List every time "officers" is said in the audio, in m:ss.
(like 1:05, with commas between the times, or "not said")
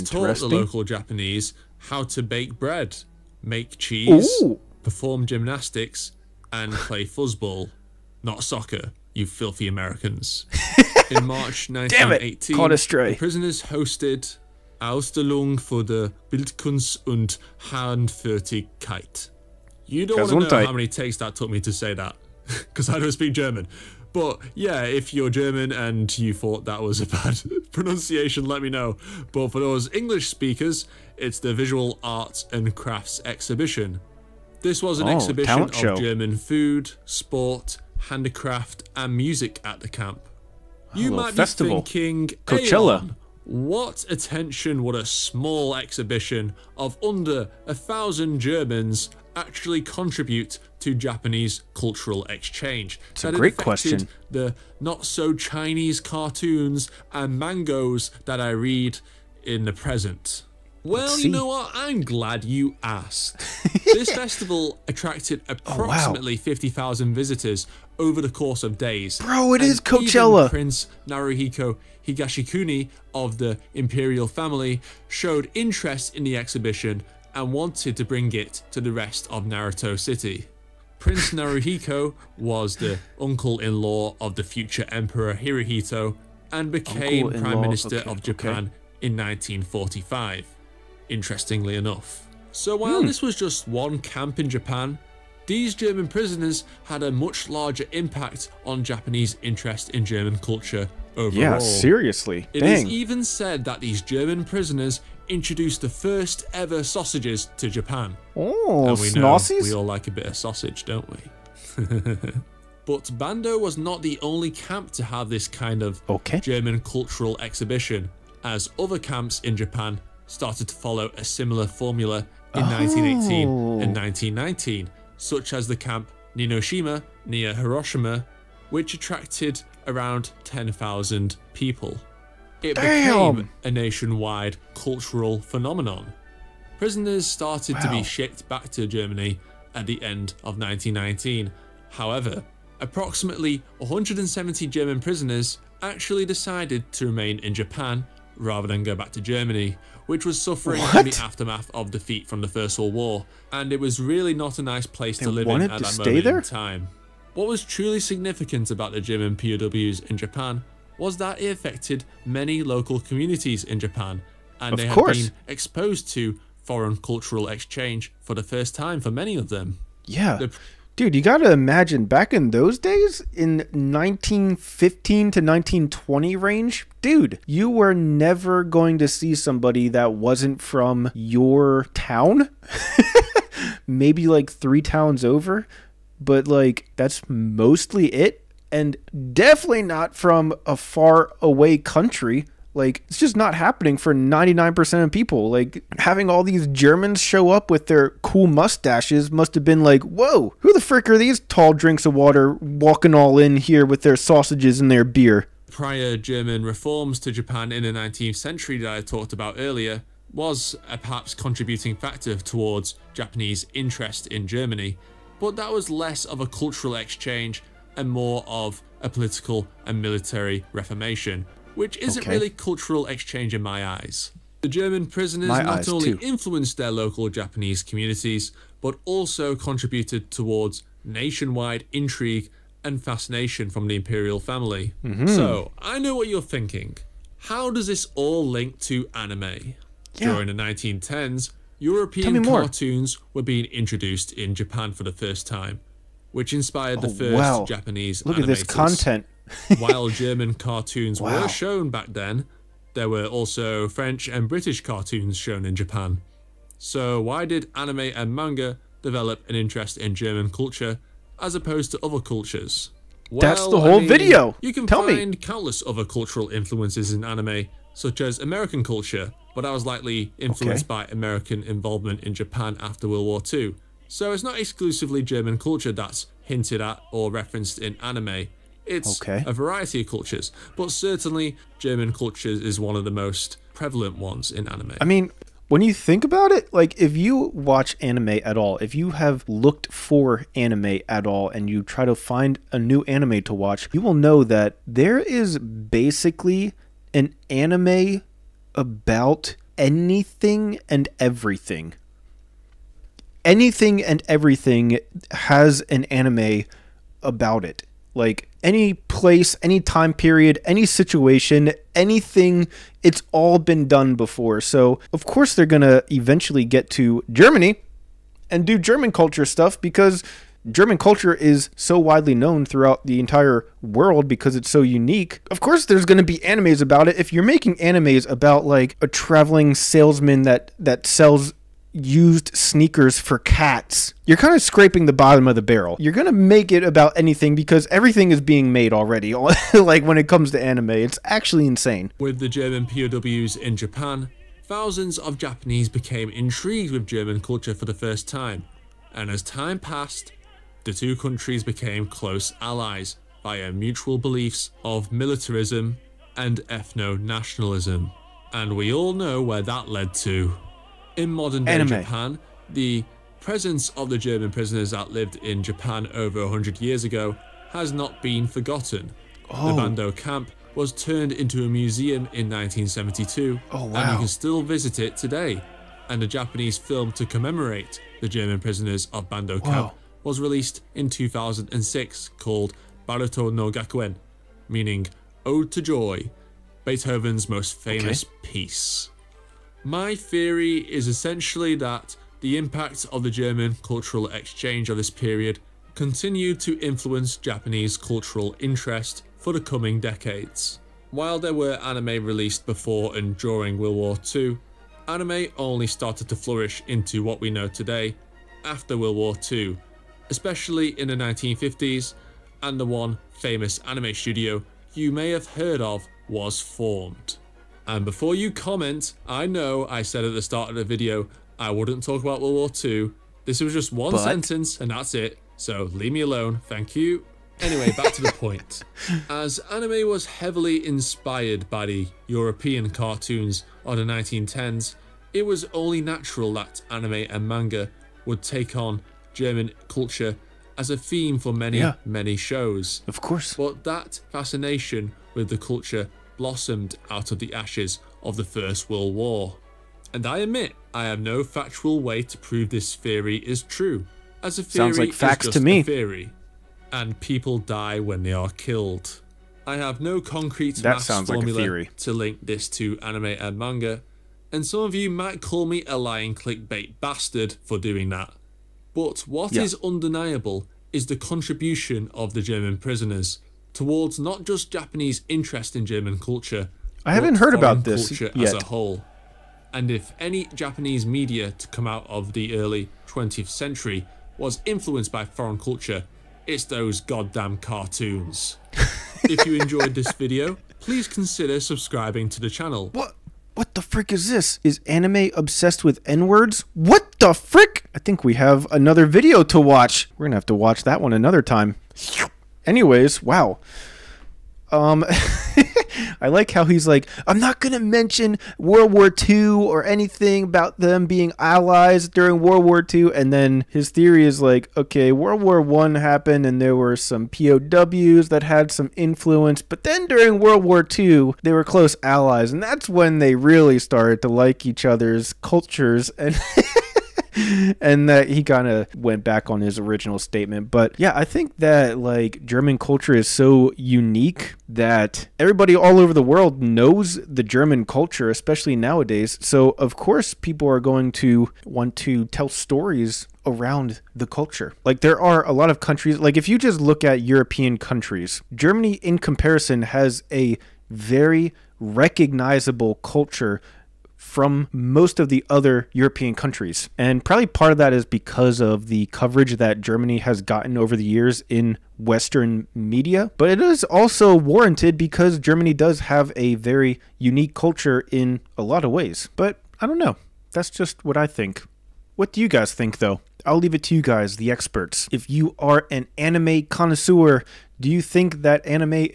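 not said.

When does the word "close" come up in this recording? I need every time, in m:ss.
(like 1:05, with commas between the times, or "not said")
5:52, 8:41.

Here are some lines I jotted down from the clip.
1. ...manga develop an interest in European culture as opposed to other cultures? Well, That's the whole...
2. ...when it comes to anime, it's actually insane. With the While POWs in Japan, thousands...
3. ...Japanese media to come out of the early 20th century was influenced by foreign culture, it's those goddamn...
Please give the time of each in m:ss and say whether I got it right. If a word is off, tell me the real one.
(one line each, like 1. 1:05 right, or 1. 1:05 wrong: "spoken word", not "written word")
1. 4:18 wrong: "German", not "European"
2. 5:40 wrong: "German", not "While"
3. 8:00 right.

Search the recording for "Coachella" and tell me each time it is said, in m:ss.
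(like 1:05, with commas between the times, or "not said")
0:42, 1:09.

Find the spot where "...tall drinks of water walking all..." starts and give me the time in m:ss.
3:21.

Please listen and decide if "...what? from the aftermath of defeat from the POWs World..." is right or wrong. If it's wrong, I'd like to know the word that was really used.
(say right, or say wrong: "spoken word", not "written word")
wrong: "First", not "POWs".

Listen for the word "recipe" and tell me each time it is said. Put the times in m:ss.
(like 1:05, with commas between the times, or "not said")
not said.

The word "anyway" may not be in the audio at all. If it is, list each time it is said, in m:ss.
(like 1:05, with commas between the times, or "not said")
7:07, 8:22.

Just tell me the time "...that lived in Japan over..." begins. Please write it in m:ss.
6:04.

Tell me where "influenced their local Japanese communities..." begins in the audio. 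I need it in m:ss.
3:46.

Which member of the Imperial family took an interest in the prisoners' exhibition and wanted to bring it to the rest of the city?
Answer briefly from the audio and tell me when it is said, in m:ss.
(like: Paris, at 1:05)
Prince Naruhiko Higashikuni, at 1:10.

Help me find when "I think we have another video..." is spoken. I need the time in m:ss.
8:17.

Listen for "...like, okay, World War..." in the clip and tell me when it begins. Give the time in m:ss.
8:34.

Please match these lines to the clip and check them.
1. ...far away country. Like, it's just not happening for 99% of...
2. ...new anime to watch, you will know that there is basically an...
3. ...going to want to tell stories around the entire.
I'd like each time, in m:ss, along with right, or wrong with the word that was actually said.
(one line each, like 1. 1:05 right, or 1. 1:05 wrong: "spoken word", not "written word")
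1. 3:10 right
2. 4:52 right
3. 9:00 wrong: "culture", not "entire".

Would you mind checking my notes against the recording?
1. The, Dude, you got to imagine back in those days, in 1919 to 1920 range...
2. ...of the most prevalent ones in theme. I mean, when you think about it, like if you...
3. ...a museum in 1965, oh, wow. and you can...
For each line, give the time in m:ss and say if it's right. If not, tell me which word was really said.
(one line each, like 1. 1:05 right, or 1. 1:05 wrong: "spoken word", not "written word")
1. 2:50 wrong: "1915", not "1919"
2. 4:42 wrong: "anime", not "theme"
3. 6:11 wrong: "1972", not "1965".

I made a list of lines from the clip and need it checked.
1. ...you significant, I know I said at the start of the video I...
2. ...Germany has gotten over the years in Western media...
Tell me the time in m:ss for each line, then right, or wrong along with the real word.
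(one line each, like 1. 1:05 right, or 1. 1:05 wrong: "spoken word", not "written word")
1. 6:58 wrong: "comment", not "significant"
2. 9:19 right.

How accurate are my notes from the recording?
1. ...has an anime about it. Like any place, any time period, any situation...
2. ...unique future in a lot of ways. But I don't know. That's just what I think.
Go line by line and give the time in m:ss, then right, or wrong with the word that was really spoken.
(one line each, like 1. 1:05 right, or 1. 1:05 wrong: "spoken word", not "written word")
1. 5:05 right
2. 9:27 wrong: "culture", not "future".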